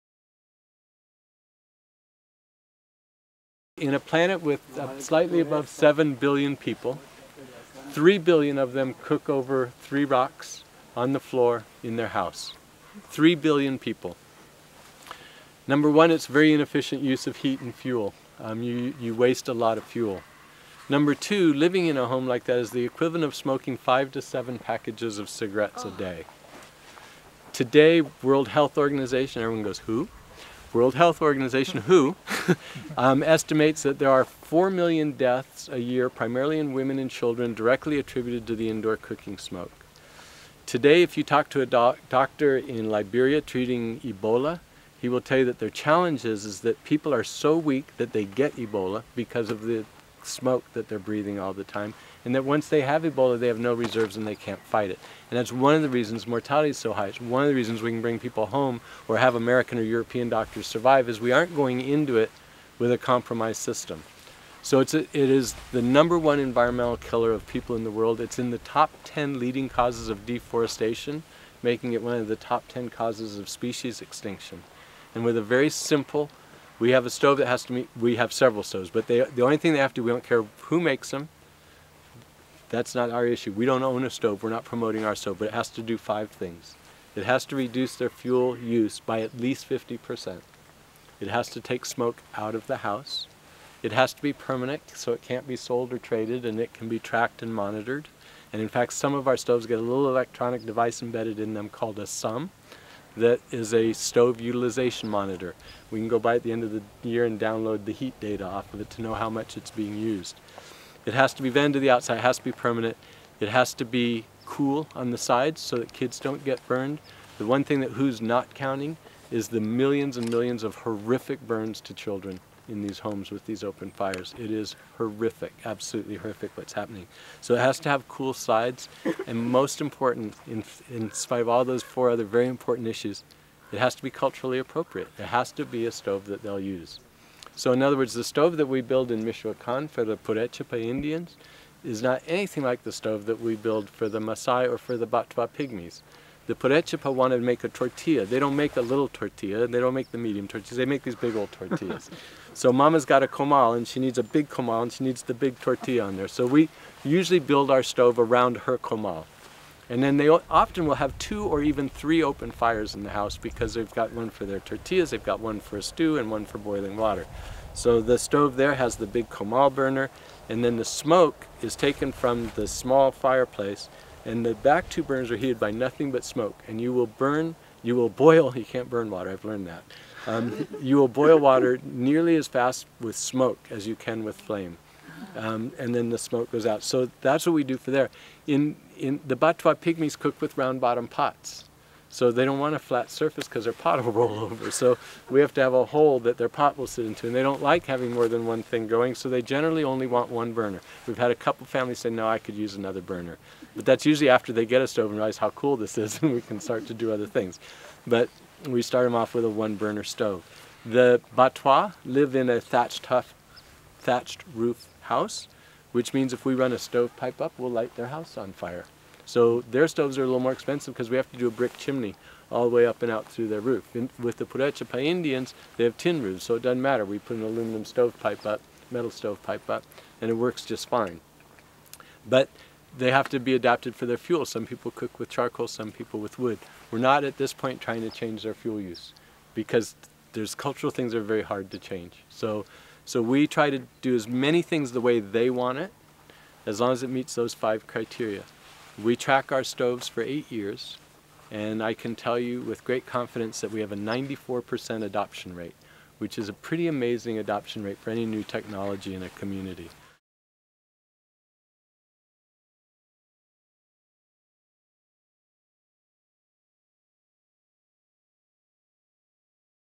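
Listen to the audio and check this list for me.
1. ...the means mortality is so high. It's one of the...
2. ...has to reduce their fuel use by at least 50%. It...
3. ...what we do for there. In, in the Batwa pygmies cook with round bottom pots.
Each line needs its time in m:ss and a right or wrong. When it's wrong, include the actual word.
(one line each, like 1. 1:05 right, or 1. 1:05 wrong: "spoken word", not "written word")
1. 0:55 wrong: "reasons", not "means"
2. 1:27 right
3. 3:07 right.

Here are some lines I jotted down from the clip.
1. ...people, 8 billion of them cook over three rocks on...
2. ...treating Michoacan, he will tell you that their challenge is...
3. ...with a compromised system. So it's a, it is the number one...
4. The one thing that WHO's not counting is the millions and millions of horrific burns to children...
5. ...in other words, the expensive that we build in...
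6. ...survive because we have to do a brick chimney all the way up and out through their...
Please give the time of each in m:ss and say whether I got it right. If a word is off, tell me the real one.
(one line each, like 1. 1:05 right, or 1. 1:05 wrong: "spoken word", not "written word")
1. 0:06 wrong: "3", not "8"
2. 0:43 wrong: "Ebola", not "Michoacan"
3. 1:02 right
4. 1:57 right
5. 2:17 wrong: "stove", not "expensive"
6. 3:40 wrong: "expensive", not "survive".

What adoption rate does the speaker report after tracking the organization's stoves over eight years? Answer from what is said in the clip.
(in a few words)
94%.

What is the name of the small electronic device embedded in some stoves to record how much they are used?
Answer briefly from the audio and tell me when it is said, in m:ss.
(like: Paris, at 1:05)
stove utilization monitor, at 1:43.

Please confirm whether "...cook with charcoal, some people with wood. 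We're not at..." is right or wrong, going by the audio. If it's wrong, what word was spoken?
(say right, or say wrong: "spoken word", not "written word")
right.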